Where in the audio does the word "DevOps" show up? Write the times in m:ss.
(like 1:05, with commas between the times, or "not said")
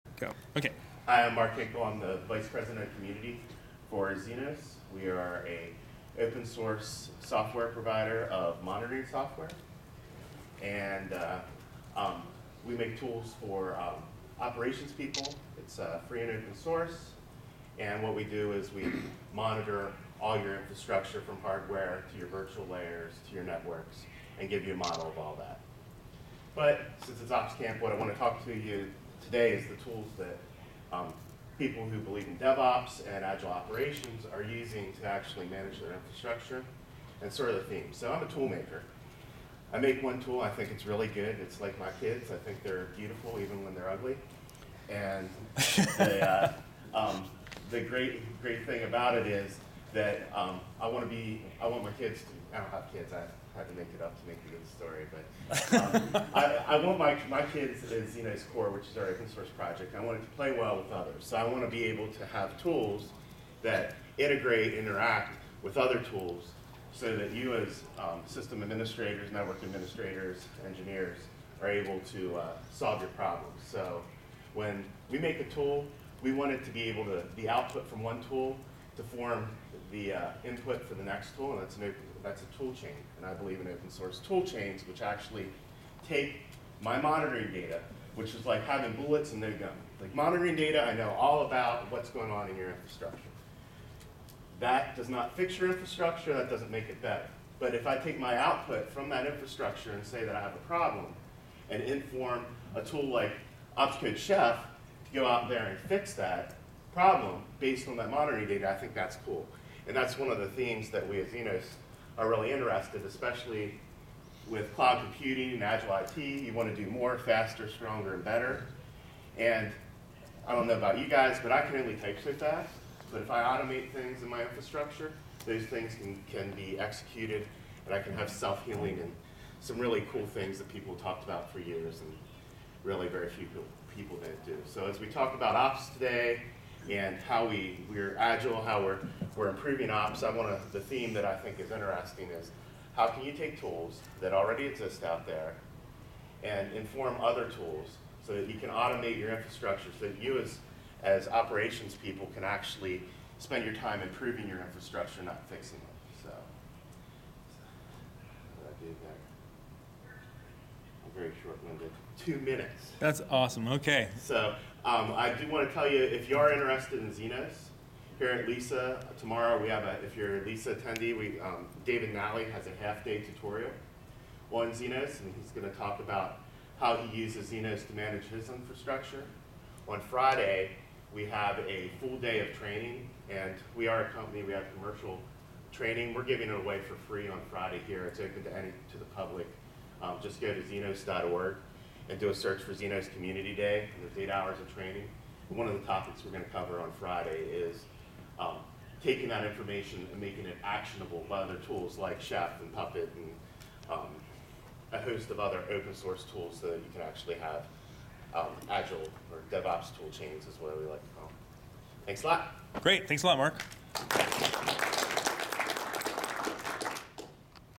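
0:32, 3:29.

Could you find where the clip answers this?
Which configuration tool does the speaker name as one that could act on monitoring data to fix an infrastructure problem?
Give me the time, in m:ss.
1:43.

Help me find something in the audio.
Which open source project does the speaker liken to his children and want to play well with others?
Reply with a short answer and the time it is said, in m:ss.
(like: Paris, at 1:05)
Zenoss Core, at 0:58.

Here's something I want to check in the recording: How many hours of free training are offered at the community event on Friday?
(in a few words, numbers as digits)
8.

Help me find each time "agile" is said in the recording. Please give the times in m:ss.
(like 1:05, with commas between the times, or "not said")
0:33, 1:55, 2:18, 3:28.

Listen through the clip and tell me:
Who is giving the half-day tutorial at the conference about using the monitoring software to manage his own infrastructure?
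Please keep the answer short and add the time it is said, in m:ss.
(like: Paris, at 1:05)
David Nalley, at 2:51.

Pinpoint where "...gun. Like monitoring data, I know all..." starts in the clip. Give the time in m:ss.
1:29.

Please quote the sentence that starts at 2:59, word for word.
On Friday, we have a full day of training, and we are a company.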